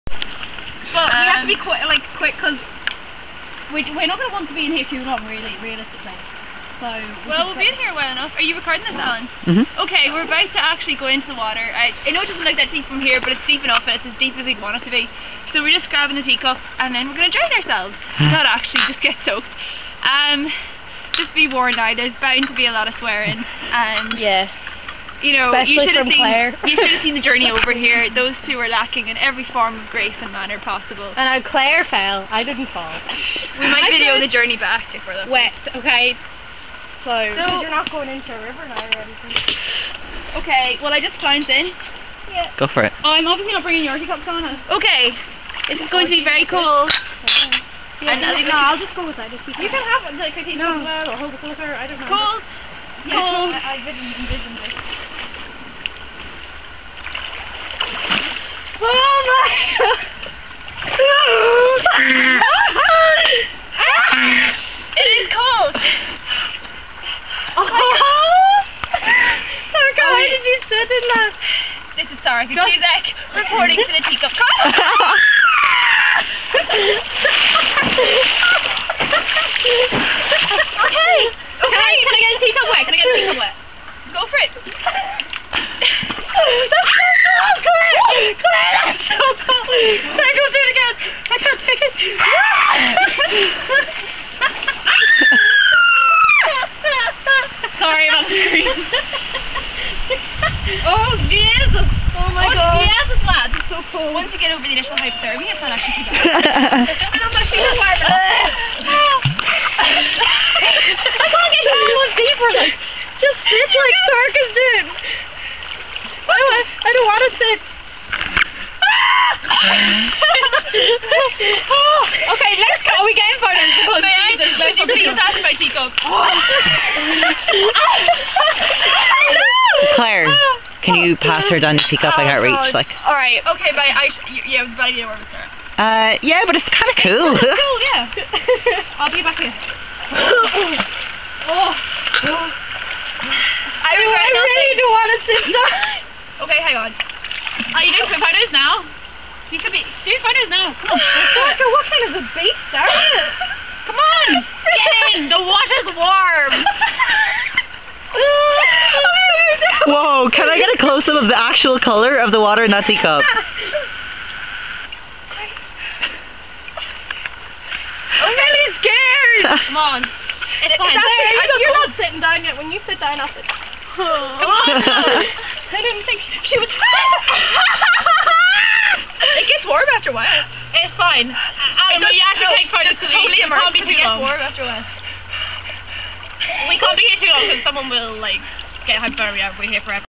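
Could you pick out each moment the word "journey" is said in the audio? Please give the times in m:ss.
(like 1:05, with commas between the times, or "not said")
0:27, 0:34.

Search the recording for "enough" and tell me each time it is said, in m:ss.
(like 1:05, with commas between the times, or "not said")
0:08, 0:13.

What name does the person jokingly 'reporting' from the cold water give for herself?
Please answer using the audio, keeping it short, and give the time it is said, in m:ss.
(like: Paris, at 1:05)
Sarah, at 1:12.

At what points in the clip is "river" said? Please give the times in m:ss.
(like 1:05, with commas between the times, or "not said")
0:38.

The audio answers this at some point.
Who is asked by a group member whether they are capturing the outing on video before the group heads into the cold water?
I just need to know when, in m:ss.
0:08.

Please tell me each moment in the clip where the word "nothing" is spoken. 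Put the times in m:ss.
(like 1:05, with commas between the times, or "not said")
2:24.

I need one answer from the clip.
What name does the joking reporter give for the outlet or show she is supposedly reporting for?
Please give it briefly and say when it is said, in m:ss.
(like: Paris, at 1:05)
Teacup Coffee, at 1:14.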